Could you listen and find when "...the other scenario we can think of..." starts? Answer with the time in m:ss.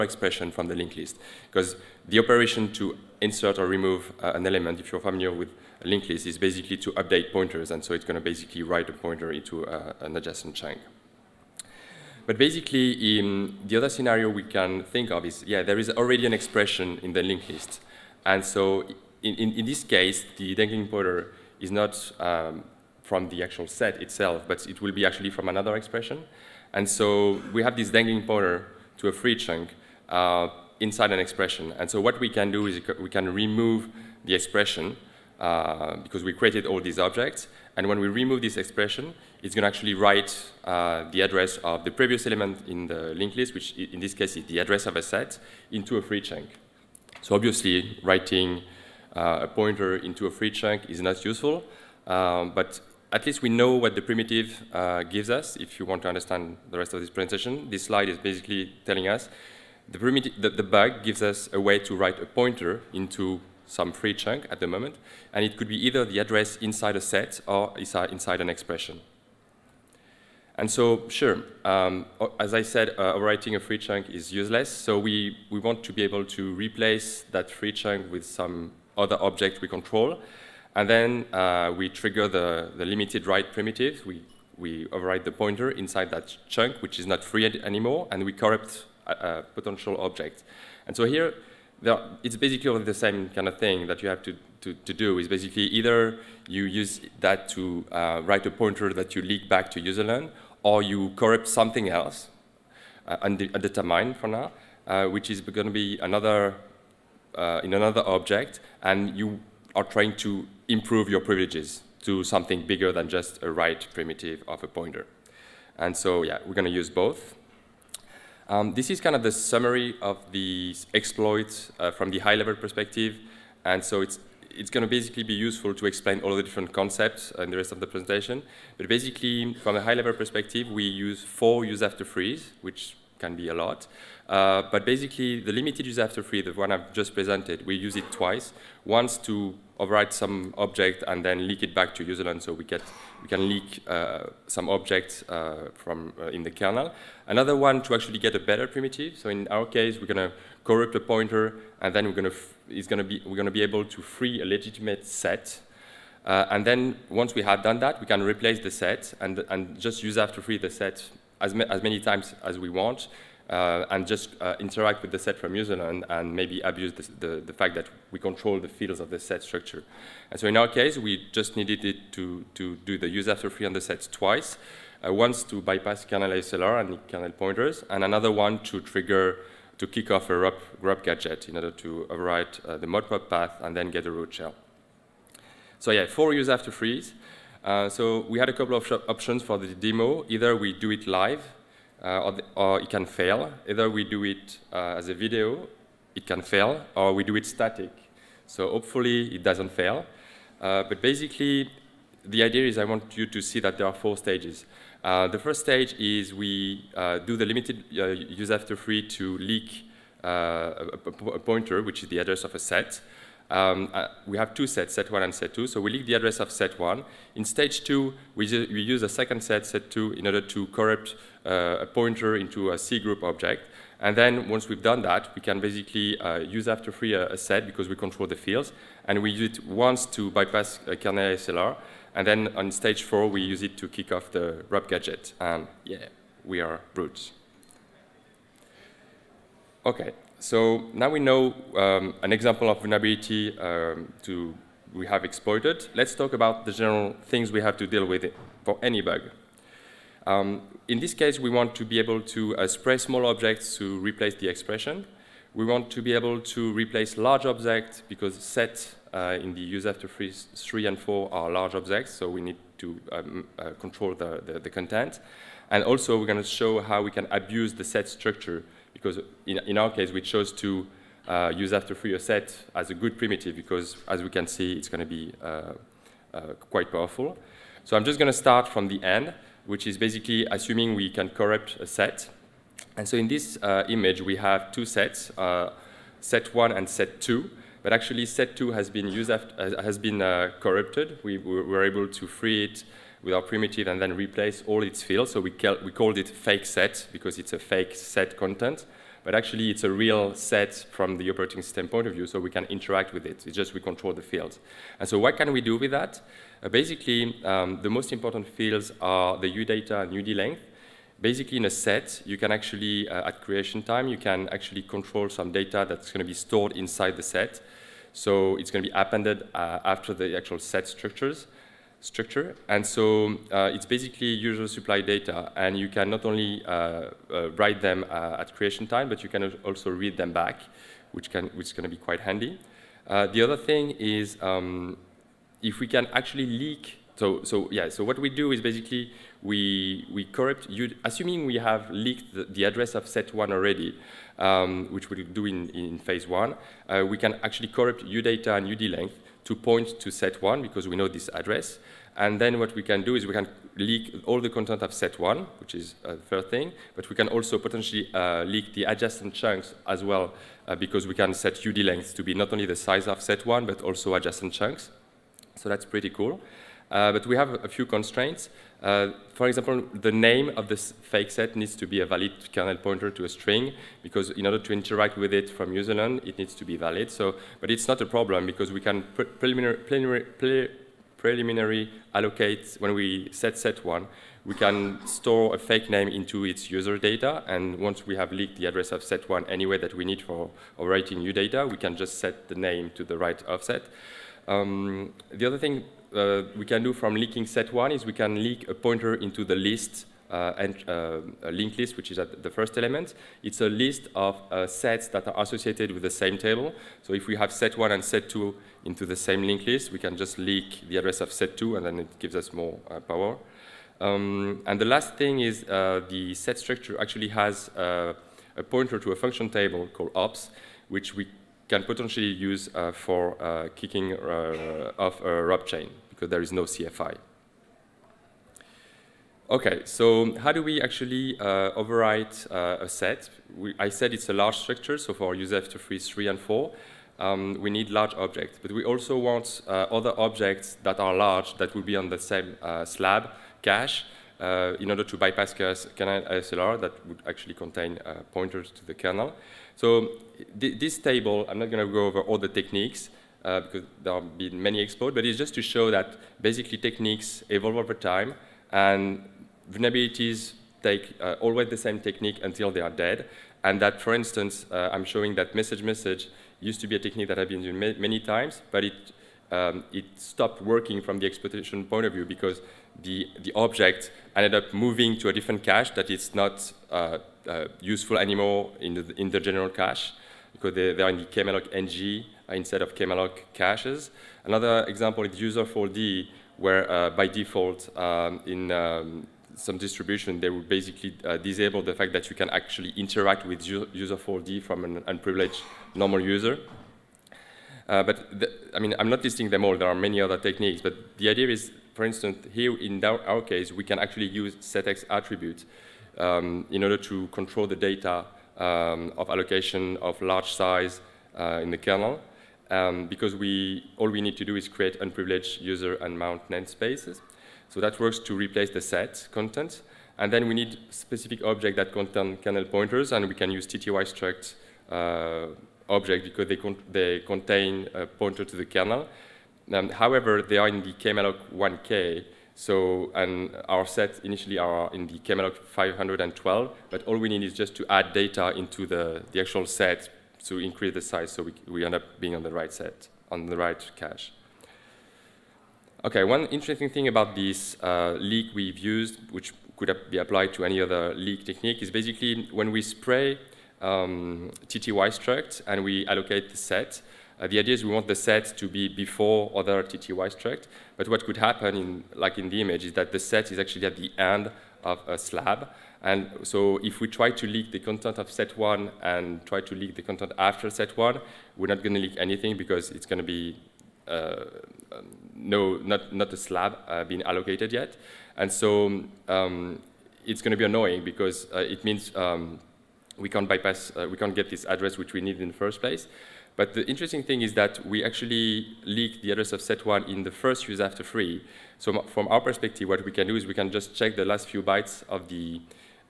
0:13.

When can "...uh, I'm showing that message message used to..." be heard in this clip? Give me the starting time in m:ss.
7:44.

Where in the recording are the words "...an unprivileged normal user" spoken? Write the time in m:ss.
8:14.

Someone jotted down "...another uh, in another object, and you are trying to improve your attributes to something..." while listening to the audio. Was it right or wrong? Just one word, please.
wrong.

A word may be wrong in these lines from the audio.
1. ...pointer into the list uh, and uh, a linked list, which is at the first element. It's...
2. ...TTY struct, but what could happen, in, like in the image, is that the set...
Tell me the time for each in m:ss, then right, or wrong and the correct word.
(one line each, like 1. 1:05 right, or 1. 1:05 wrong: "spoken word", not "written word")
1. 6:38 right
2. 9:19 right.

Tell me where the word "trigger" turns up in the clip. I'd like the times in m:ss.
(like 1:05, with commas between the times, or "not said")
1:21, 2:58.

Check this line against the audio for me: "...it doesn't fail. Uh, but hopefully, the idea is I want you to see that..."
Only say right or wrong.
wrong.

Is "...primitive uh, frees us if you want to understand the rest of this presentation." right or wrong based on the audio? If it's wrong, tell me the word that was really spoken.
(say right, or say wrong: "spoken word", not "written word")
wrong: "gives", not "frees".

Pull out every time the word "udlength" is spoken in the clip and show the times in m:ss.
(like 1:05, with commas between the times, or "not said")
5:10, 5:48.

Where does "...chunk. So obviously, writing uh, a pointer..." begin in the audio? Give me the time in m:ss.
0:46.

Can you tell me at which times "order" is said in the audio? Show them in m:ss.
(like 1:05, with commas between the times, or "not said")
3:01, 3:40, 6:14, 7:24, 8:26.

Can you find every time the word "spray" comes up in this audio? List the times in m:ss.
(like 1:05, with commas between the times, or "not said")
4:12, 9:12.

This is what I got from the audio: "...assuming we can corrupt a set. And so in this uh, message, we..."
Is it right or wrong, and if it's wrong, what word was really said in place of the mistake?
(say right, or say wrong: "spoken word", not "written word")
wrong: "image", not "message".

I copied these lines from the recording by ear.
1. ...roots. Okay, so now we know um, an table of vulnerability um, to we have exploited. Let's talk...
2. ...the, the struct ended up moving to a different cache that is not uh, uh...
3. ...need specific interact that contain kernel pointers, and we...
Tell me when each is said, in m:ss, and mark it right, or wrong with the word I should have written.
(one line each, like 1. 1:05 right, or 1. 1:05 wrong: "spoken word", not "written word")
1. 3:56 wrong: "example", not "table"
2. 7:53 wrong: "object", not "struct"
3. 8:40 wrong: "object", not "interact".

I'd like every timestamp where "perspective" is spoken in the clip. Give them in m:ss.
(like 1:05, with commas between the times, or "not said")
2:02, 2:10, 9:52.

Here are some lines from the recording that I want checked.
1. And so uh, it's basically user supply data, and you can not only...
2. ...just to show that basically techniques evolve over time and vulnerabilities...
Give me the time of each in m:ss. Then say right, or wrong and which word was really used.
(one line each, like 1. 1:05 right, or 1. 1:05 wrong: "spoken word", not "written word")
1. 5:22 right
2. 7:35 right.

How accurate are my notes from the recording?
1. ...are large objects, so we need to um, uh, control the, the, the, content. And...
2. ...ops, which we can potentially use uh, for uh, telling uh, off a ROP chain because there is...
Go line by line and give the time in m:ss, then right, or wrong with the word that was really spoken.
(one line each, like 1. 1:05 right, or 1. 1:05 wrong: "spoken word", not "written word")
1. 4:21 right
2. 7:00 wrong: "kicking", not "telling".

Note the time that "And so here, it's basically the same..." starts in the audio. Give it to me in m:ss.
1:30.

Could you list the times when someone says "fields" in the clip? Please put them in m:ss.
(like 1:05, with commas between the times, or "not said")
2:48, 3:48, 4:55, 5:04, 5:08.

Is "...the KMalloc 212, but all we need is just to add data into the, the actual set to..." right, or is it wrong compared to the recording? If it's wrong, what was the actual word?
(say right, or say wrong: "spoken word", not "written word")
wrong: "512", not "212".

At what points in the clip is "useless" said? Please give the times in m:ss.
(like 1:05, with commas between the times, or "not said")
1:14.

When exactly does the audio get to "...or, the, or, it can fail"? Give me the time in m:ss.
3:12.